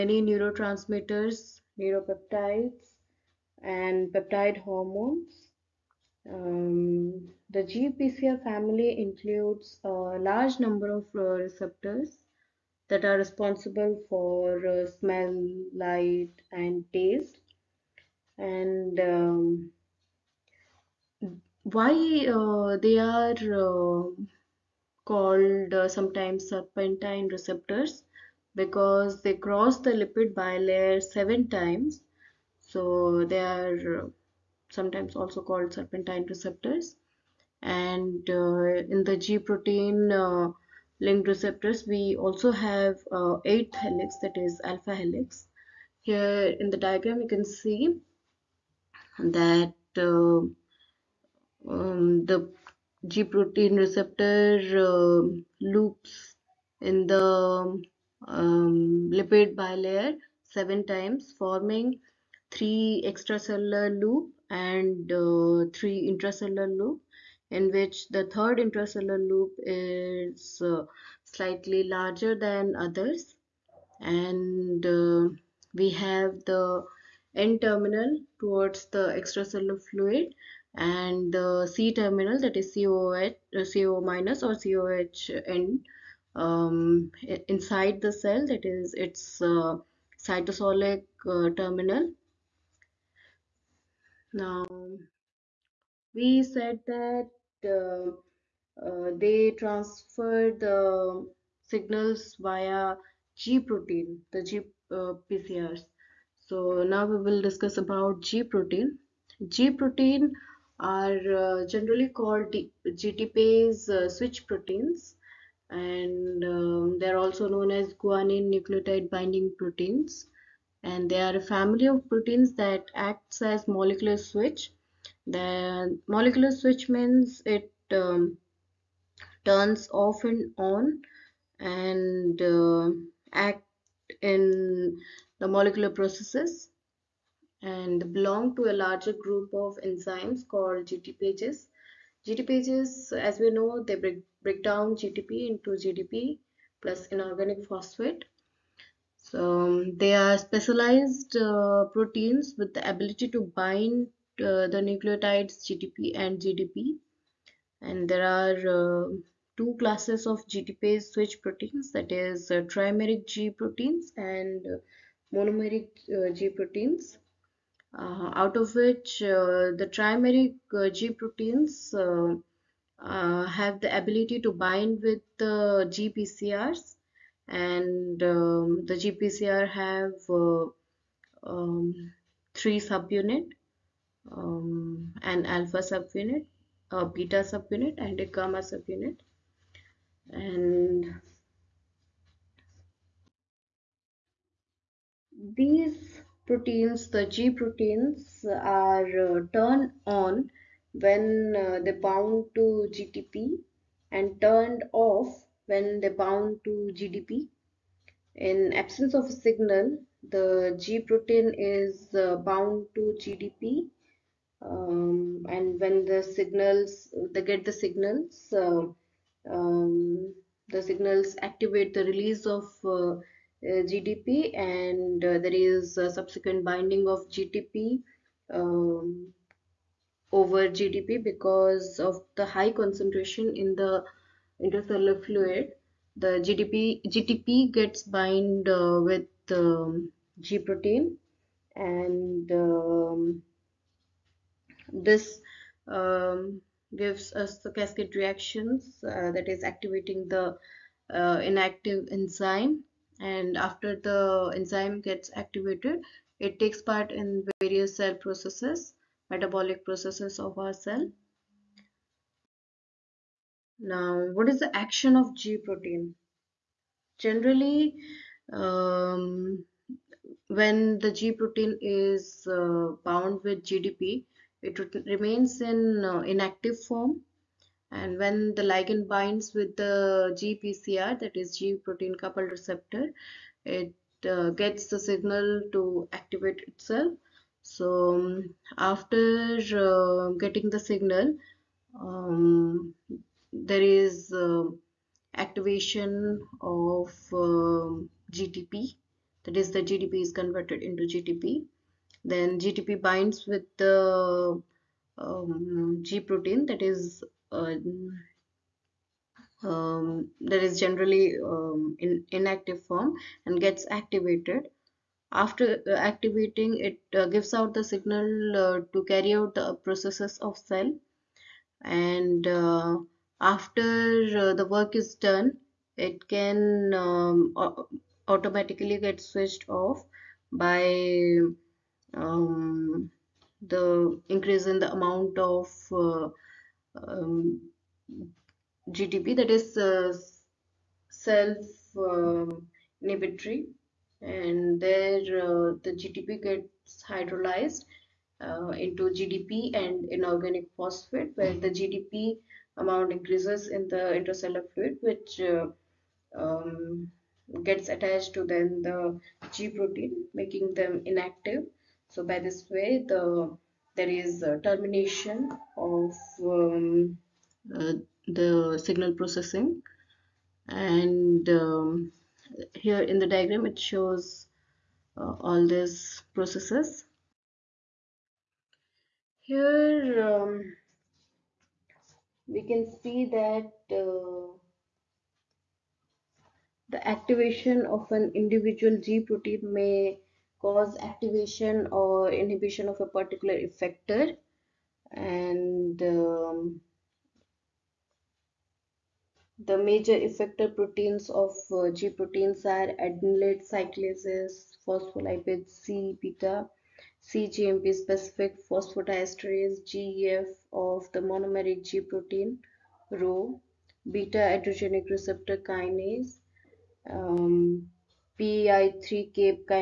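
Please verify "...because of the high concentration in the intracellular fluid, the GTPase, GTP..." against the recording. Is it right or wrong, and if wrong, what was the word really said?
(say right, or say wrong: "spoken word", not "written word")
wrong: "GDP", not "GTPase".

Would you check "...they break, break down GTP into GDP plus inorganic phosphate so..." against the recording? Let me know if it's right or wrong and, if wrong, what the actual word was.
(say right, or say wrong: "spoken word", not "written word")
right.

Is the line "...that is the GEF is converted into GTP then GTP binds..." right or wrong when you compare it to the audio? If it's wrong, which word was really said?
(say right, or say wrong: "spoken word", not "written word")
wrong: "GTP", not "GEF".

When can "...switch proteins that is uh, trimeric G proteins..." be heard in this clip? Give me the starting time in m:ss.
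2:41.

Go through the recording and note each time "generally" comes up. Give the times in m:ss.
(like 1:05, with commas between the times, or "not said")
1:51, 4:27, 5:10.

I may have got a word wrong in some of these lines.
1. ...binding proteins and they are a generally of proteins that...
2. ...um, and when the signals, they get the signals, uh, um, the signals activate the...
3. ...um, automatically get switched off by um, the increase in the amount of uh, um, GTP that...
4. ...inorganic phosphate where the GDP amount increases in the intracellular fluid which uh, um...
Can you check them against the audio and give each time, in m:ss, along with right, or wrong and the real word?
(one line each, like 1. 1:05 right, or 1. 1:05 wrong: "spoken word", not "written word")
1. 1:59 wrong: "family", not "generally"
2. 3:34 right
3. 5:26 right
4. 5:50 right.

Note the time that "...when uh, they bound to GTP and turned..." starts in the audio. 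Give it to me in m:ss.
3:20.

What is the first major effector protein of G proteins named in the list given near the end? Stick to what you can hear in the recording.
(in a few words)
adenylate cyclases.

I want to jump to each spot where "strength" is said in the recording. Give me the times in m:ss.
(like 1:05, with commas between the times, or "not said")
not said.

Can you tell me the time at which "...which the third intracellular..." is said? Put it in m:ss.
1:07.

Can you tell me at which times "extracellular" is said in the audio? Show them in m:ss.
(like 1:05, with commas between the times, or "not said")
1:03, 1:19.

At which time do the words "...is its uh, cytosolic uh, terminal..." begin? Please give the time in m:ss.
1:28.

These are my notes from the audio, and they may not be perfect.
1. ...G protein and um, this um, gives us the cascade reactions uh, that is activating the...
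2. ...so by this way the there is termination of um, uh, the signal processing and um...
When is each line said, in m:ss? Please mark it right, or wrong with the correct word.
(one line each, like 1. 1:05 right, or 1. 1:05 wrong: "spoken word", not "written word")
1. 4:00 right
2. 6:02 right.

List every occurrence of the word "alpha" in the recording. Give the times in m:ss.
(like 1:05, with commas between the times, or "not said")
0:44, 3:05.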